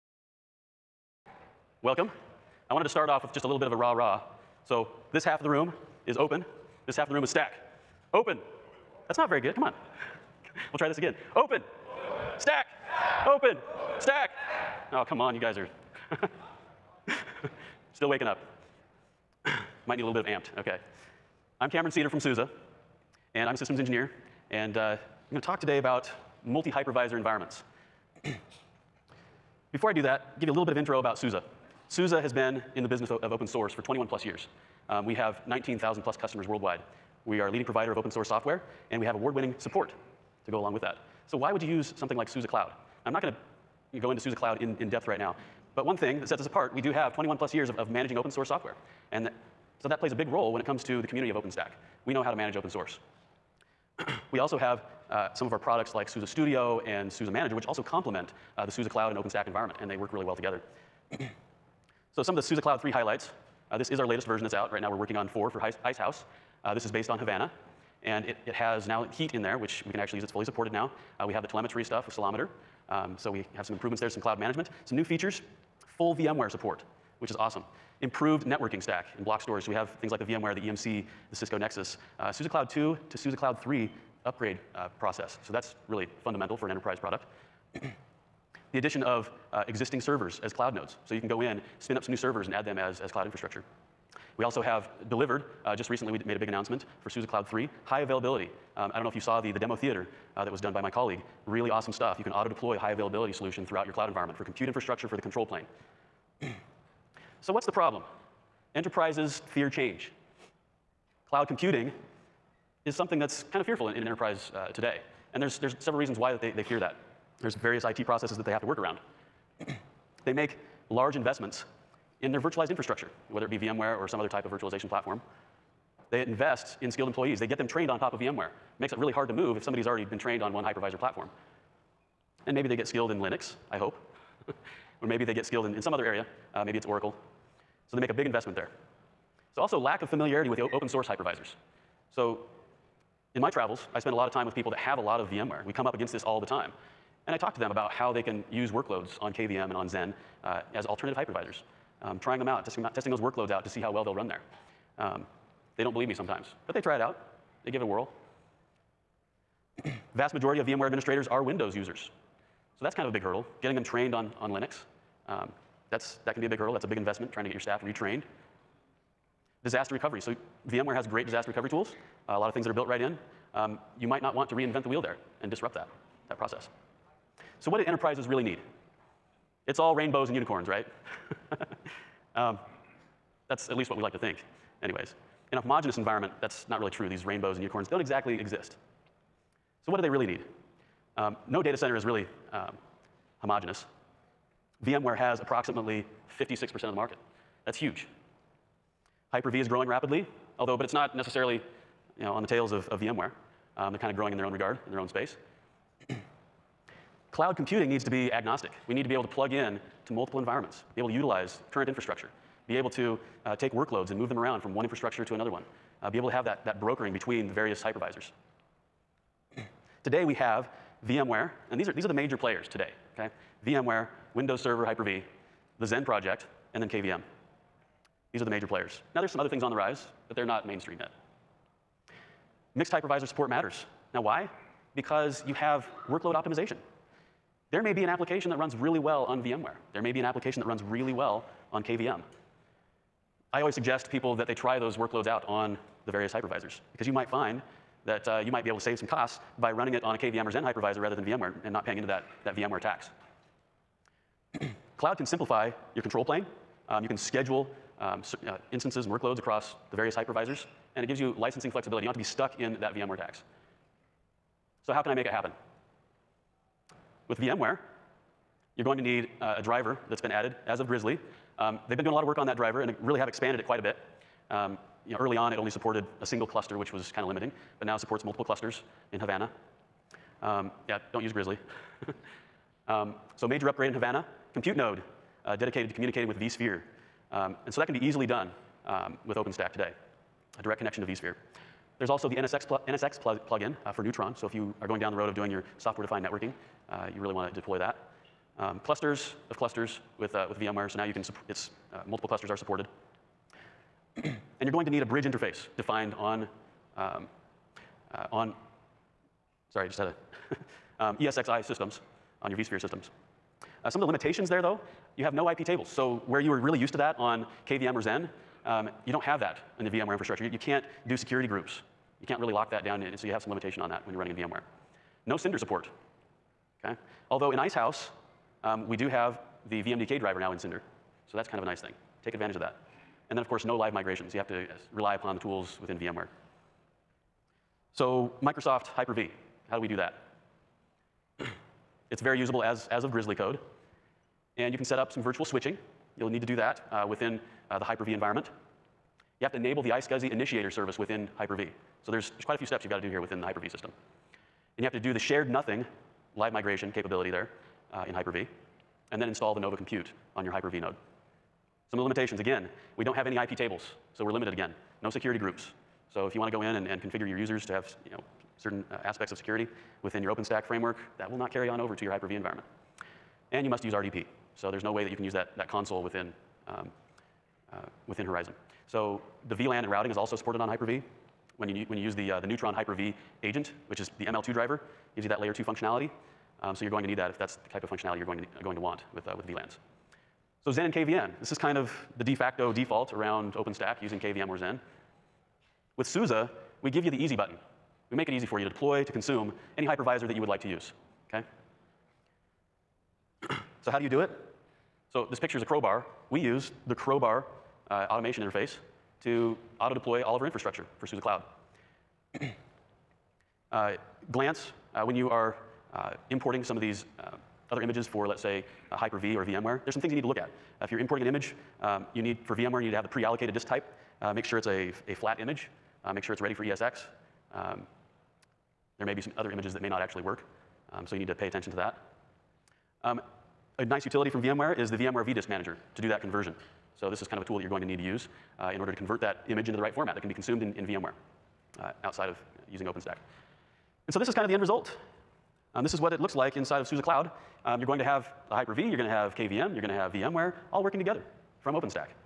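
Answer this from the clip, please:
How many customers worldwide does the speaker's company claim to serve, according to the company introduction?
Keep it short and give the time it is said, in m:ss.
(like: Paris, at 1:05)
19,000 plus, at 0:35.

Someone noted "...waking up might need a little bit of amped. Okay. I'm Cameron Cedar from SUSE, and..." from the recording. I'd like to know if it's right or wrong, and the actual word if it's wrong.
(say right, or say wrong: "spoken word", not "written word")
right.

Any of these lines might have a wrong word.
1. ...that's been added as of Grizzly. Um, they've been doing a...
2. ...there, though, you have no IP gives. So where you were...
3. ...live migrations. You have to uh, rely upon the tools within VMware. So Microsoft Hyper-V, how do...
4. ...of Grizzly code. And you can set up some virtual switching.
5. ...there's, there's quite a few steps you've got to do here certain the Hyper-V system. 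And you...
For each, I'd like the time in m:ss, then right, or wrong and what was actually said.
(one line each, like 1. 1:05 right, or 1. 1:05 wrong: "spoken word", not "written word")
1. 4:30 right
2. 5:14 wrong: "tables", not "gives"
3. 5:33 right
4. 5:43 right
5. 5:52 wrong: "within", not "certain".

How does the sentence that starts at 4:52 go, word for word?
There's also the NSX, pl NSX pl plugin uh, for Neutron.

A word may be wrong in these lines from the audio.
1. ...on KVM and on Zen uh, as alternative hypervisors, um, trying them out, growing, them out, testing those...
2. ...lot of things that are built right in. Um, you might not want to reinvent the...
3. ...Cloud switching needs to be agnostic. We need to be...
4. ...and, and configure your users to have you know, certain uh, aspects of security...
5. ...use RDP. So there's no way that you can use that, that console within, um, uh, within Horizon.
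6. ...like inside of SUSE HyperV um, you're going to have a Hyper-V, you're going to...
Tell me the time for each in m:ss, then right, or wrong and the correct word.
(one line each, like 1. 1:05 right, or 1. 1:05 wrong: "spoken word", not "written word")
1. 2:29 wrong: "testing", not "growing"
2. 2:52 right
3. 3:27 wrong: "computing", not "switching"
4. 6:06 right
5. 6:13 right
6. 7:26 wrong: "Cloud", not "HyperV".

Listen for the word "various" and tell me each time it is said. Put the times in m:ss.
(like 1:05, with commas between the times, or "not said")
1:57, 3:37, 4:06, 4:19.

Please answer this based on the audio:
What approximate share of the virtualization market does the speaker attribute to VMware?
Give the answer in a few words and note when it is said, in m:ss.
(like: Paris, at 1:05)
56%, at 3:16.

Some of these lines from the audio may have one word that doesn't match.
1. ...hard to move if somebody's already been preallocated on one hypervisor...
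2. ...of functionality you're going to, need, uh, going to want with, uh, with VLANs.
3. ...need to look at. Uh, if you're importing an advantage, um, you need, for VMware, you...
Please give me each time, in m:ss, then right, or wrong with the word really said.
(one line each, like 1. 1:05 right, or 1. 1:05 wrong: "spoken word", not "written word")
1. 2:09 wrong: "trained", not "preallocated"
2. 6:27 right
3. 7:00 wrong: "image", not "advantage".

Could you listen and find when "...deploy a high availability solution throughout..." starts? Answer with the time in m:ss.
1:42.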